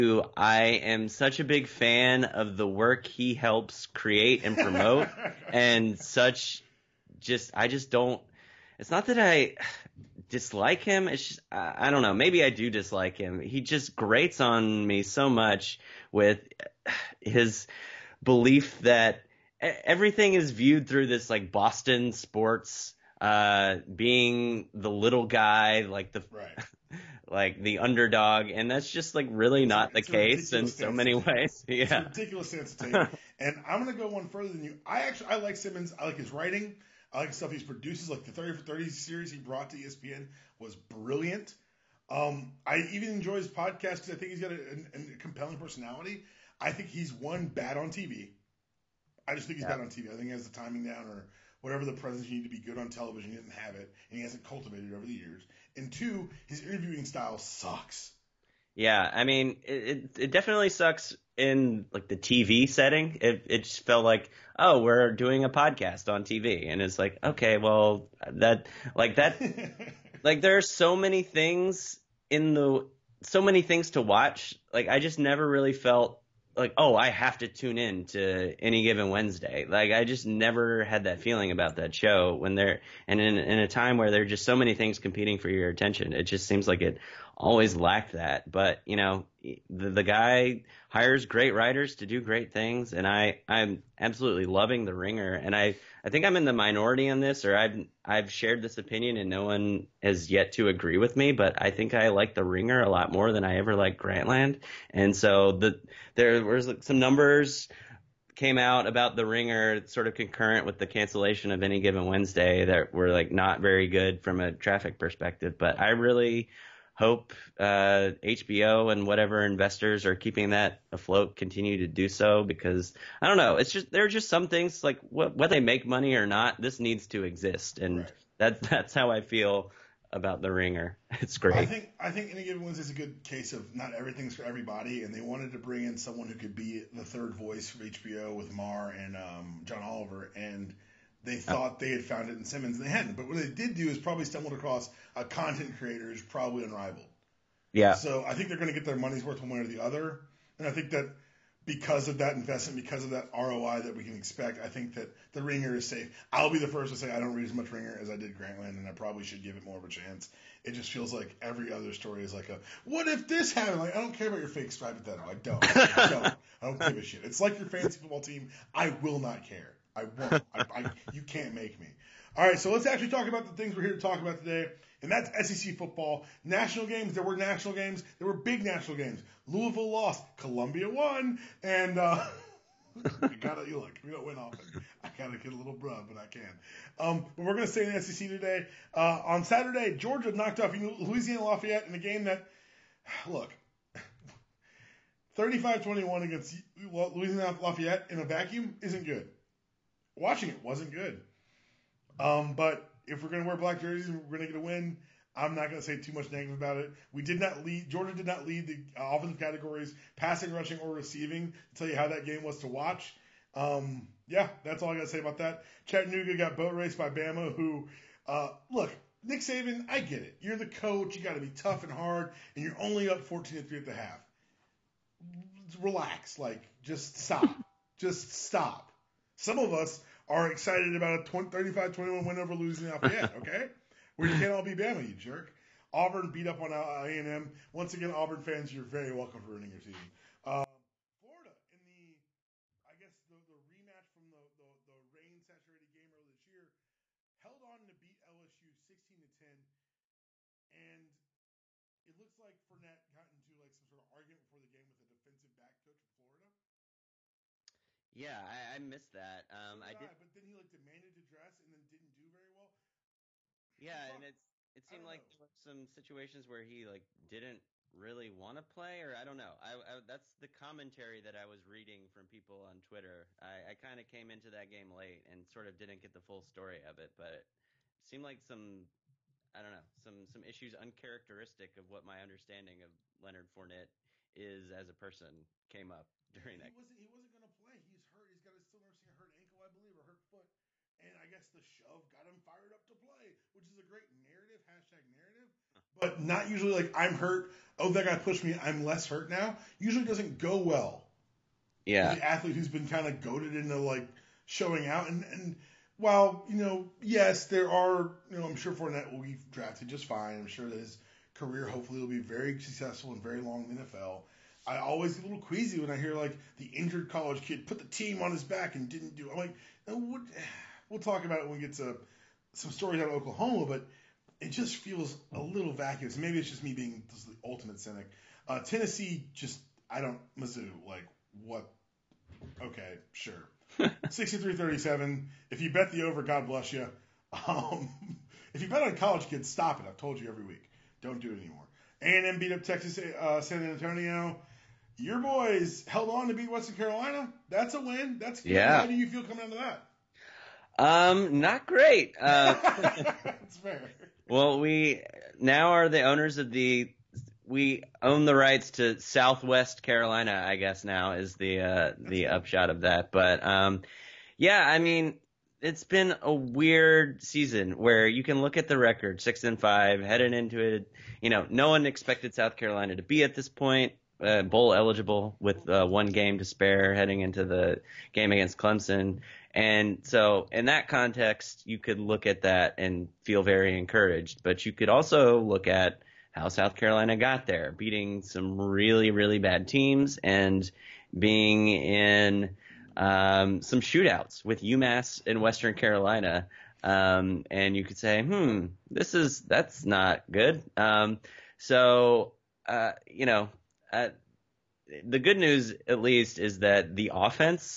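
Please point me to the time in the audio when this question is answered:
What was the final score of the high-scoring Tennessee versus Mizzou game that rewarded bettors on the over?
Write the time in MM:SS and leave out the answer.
05:33.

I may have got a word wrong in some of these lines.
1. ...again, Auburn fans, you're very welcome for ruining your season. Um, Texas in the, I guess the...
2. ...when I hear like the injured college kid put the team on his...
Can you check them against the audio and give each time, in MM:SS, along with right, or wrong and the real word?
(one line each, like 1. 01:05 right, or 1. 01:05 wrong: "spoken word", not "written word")
1. 03:57 wrong: "Florida", not "Texas"
2. 05:15 right.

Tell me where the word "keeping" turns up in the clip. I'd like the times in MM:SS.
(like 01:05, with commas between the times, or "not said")
02:00.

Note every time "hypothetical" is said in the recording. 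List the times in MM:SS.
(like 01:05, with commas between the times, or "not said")
02:44.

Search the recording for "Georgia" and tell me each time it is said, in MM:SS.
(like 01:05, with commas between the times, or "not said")
03:09, 03:27.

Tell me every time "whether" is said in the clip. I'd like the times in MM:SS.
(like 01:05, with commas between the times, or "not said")
02:05.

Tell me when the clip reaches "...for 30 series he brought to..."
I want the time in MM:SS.
00:38.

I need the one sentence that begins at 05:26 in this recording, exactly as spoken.
Maybe it's just me being just the ultimate cynic.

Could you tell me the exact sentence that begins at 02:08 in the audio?
that's that's how I feel about the Ringer.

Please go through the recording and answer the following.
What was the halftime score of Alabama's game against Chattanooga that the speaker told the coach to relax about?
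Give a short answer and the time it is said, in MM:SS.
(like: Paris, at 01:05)
14 to 3, at 03:43.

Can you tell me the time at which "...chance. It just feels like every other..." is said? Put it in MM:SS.
02:39.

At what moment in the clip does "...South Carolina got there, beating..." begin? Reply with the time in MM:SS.
06:26.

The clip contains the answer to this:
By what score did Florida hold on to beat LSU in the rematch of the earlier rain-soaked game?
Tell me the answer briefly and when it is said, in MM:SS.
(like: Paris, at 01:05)
16 to 10, at 04:08.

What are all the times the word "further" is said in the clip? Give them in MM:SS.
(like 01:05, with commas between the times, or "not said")
00:34.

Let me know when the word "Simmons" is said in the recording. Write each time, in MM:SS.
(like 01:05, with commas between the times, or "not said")
00:35, 02:22.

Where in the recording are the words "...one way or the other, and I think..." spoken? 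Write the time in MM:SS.
02:29.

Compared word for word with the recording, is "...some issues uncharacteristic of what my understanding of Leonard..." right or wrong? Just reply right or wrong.
right.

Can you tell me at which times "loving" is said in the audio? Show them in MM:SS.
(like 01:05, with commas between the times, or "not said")
01:34.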